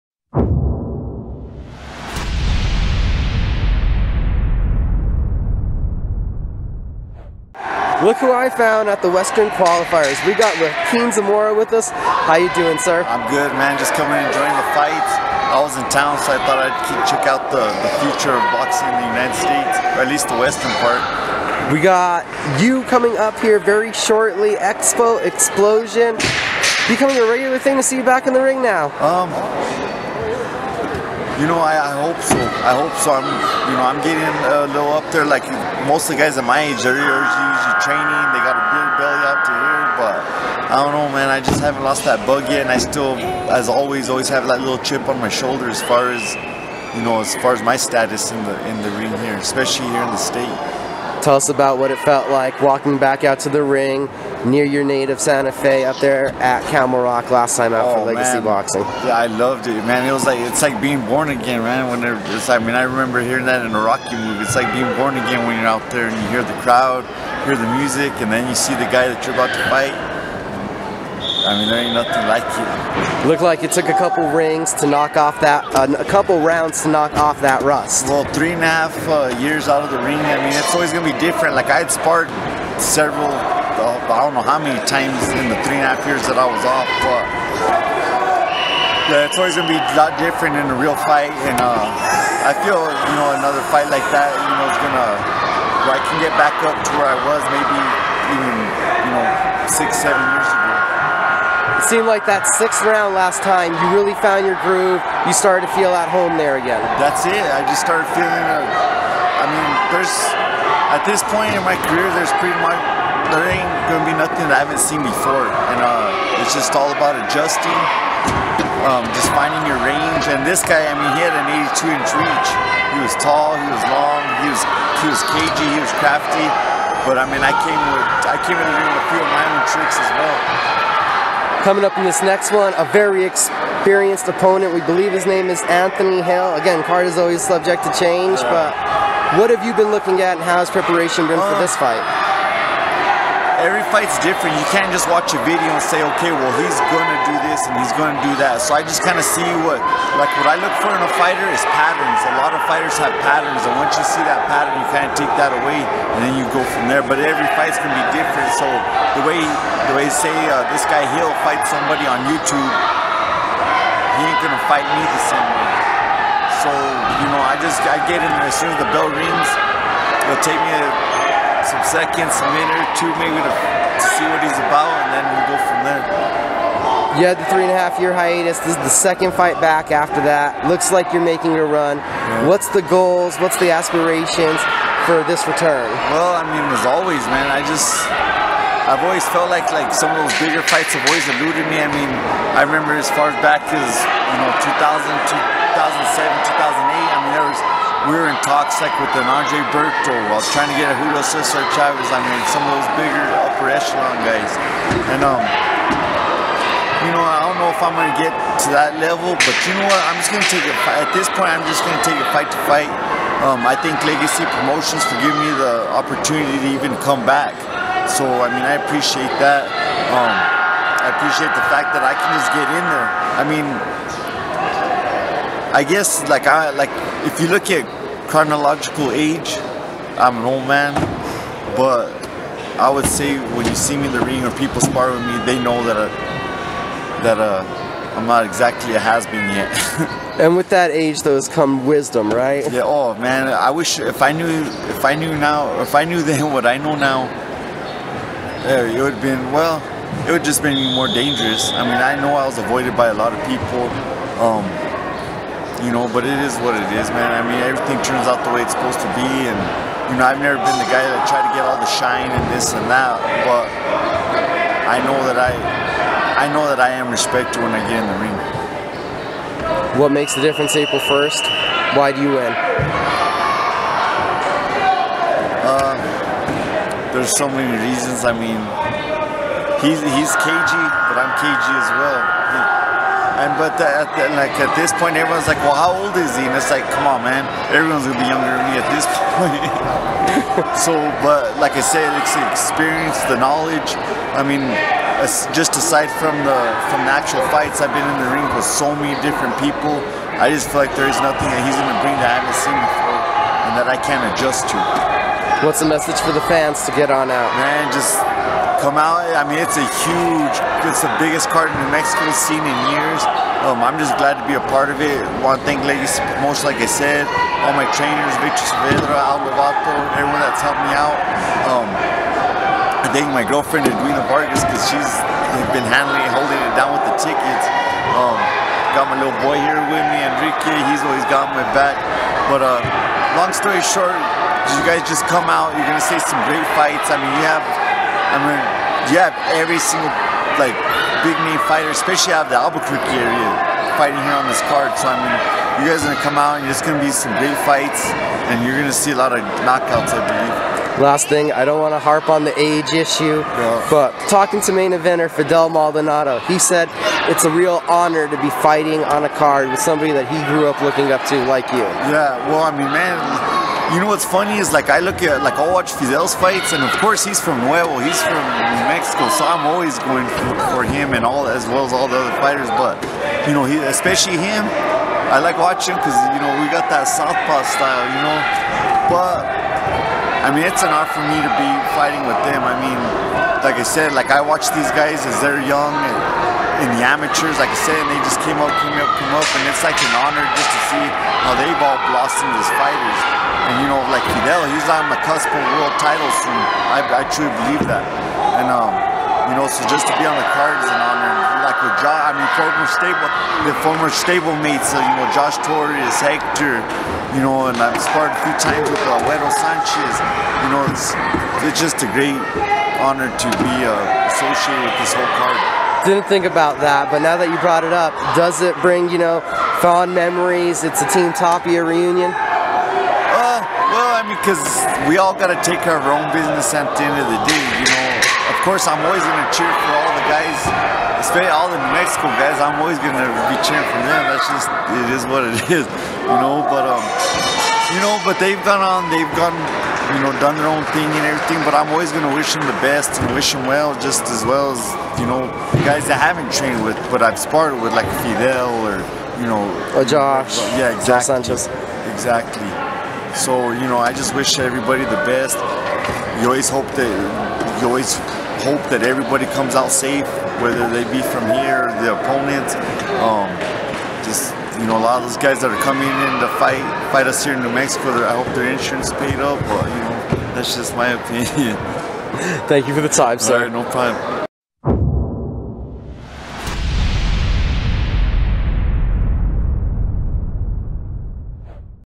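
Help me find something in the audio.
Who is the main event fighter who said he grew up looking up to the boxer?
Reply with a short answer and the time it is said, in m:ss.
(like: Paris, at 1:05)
Fidel Maldonado, at 5:55.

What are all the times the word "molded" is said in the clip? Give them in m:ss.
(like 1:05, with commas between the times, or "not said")
not said.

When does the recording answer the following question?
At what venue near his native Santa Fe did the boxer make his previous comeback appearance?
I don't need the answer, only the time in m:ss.
0:56.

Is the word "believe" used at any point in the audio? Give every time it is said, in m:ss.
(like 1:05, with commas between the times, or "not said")
2:14, 5:50, 6:37.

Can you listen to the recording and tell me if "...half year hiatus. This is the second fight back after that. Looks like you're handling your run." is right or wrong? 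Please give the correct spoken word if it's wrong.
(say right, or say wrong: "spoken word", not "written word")
wrong: "making", not "handling".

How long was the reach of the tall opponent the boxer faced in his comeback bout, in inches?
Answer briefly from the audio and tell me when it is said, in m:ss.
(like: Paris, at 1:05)
82, at 2:01.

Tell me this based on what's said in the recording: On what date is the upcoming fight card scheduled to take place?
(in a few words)
April 1st.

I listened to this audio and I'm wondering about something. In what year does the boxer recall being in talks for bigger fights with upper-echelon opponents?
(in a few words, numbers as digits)
2002.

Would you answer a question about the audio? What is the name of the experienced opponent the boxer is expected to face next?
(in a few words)
Anthony Hale.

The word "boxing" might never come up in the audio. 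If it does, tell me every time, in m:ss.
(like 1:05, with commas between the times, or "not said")
0:18, 0:58.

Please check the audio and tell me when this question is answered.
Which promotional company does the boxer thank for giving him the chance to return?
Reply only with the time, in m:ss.
3:34.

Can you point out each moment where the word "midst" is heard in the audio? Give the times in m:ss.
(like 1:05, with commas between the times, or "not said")
not said.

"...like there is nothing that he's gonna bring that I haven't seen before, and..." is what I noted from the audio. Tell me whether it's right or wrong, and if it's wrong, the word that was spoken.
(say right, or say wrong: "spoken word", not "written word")
right.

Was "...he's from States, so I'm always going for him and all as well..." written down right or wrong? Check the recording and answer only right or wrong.
wrong.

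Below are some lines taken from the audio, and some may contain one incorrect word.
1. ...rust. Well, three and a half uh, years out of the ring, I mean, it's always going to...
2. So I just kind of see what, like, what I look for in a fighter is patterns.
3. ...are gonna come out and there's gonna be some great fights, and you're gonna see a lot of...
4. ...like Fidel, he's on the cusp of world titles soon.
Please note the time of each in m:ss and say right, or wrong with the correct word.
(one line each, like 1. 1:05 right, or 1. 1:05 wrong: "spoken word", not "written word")
1. 1:17 right
2. 2:28 right
3. 5:46 right
4. 6:34 right.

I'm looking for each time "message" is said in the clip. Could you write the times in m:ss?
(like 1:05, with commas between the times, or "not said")
5:05.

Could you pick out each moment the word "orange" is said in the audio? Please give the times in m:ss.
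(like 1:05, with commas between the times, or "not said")
not said.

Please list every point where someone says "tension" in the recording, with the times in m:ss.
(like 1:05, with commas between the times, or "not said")
not said.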